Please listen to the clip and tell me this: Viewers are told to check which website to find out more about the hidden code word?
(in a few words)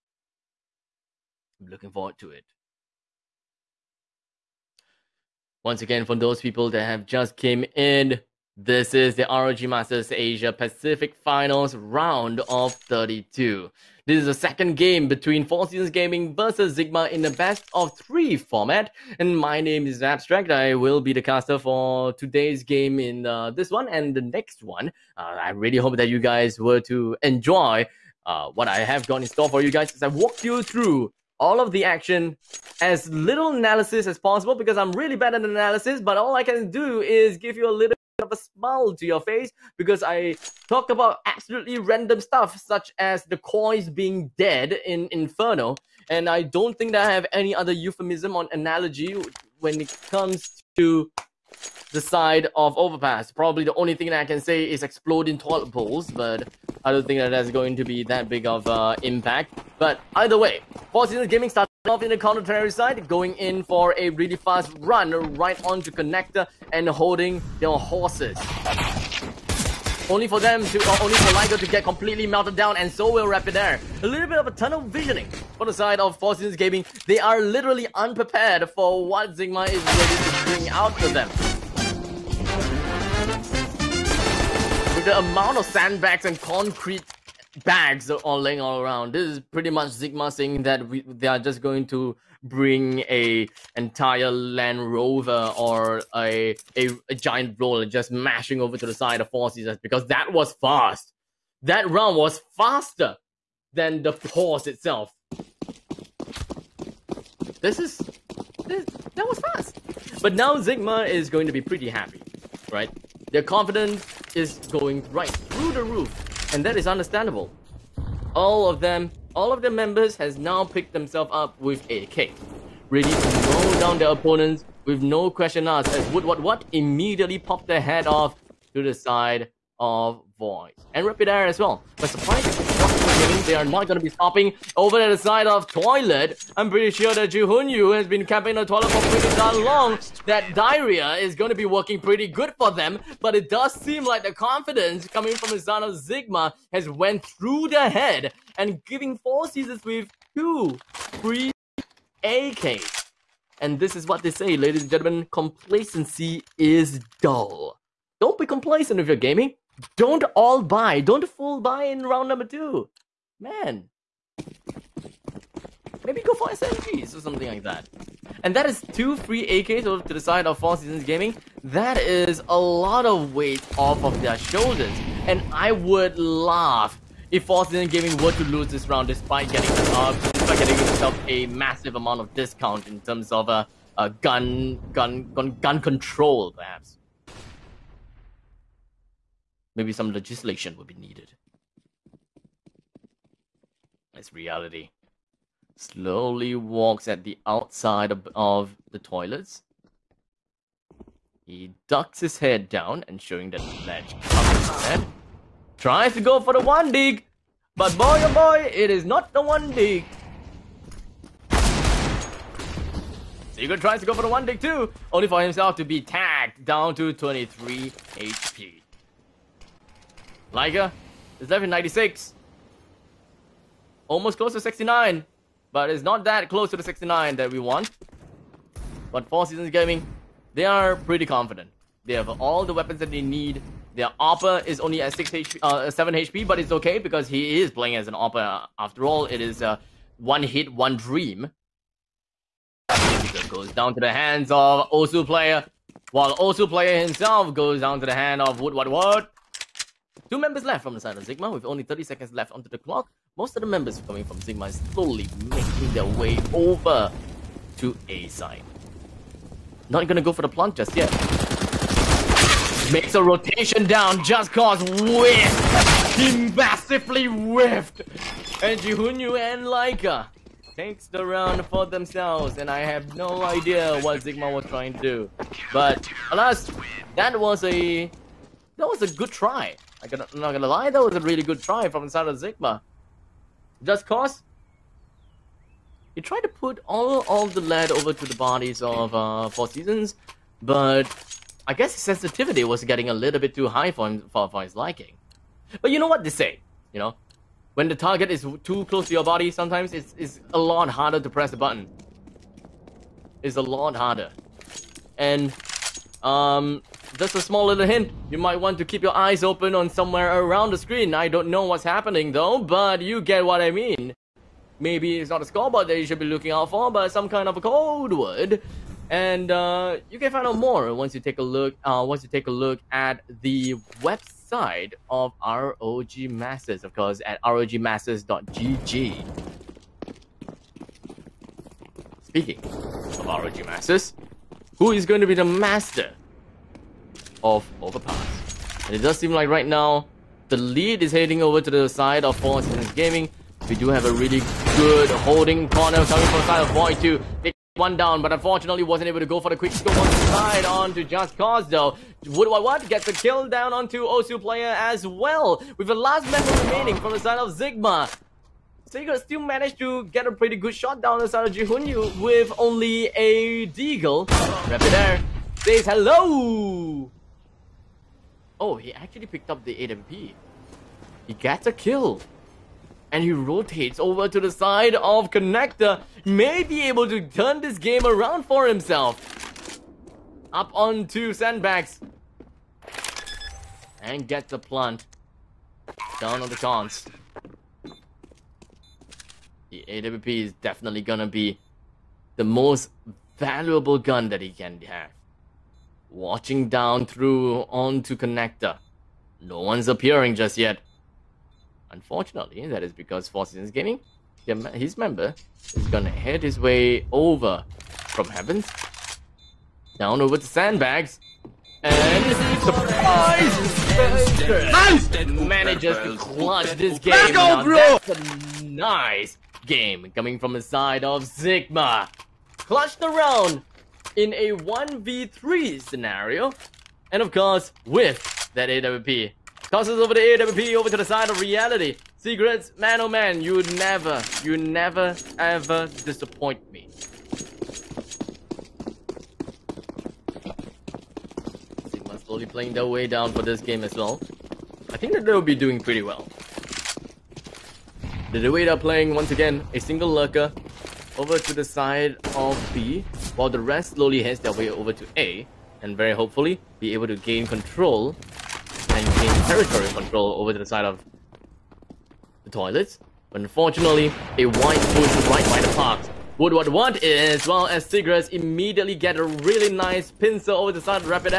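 rogmasters.gg.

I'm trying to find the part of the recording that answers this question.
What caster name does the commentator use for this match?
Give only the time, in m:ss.
0:20.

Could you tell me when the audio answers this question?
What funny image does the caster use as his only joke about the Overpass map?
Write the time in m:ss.
0:54.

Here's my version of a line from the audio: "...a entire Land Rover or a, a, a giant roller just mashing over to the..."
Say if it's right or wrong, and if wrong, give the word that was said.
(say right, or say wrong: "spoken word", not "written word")
right.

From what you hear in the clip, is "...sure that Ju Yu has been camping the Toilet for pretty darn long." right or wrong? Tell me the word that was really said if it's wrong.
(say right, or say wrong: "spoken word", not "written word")
right.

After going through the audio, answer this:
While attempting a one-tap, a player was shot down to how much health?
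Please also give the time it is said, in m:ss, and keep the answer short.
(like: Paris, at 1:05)
23 HP, at 3:37.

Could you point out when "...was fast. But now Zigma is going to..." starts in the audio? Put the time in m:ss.
1:49.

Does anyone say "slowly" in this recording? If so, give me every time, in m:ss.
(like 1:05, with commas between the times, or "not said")
3:15, 4:14, 7:22, 7:33.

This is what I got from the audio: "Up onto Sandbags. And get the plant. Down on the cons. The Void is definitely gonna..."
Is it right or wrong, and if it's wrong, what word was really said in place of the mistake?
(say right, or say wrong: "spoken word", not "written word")
wrong: "AWP", not "Void".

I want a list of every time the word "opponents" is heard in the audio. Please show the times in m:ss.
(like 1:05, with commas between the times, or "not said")
2:04.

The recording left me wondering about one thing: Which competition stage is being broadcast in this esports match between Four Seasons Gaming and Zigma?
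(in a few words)
Round of 32.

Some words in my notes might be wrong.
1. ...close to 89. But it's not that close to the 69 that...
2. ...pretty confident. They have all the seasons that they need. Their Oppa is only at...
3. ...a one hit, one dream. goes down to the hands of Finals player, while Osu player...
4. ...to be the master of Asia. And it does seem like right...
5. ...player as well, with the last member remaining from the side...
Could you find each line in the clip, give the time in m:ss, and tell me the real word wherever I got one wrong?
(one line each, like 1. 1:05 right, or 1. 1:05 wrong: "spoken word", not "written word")
1. 3:44 wrong: "69", not "89"
2. 3:50 wrong: "weapons", not "seasons"
3. 3:59 wrong: "Osu", not "Finals"
4. 5:35 wrong: "Overpass", not "Asia"
5. 5:54 right.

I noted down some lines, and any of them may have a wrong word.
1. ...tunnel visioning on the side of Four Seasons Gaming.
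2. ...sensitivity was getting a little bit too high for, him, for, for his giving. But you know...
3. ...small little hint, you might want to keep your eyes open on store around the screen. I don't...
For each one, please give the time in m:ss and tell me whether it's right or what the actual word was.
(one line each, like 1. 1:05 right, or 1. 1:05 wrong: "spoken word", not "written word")
1. 1:14 right
2. 4:52 wrong: "liking", not "giving"
3. 5:07 wrong: "somewhere", not "store".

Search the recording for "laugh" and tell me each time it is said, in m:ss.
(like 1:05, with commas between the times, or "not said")
2:56.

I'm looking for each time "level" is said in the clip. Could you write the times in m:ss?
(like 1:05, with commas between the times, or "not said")
3:41.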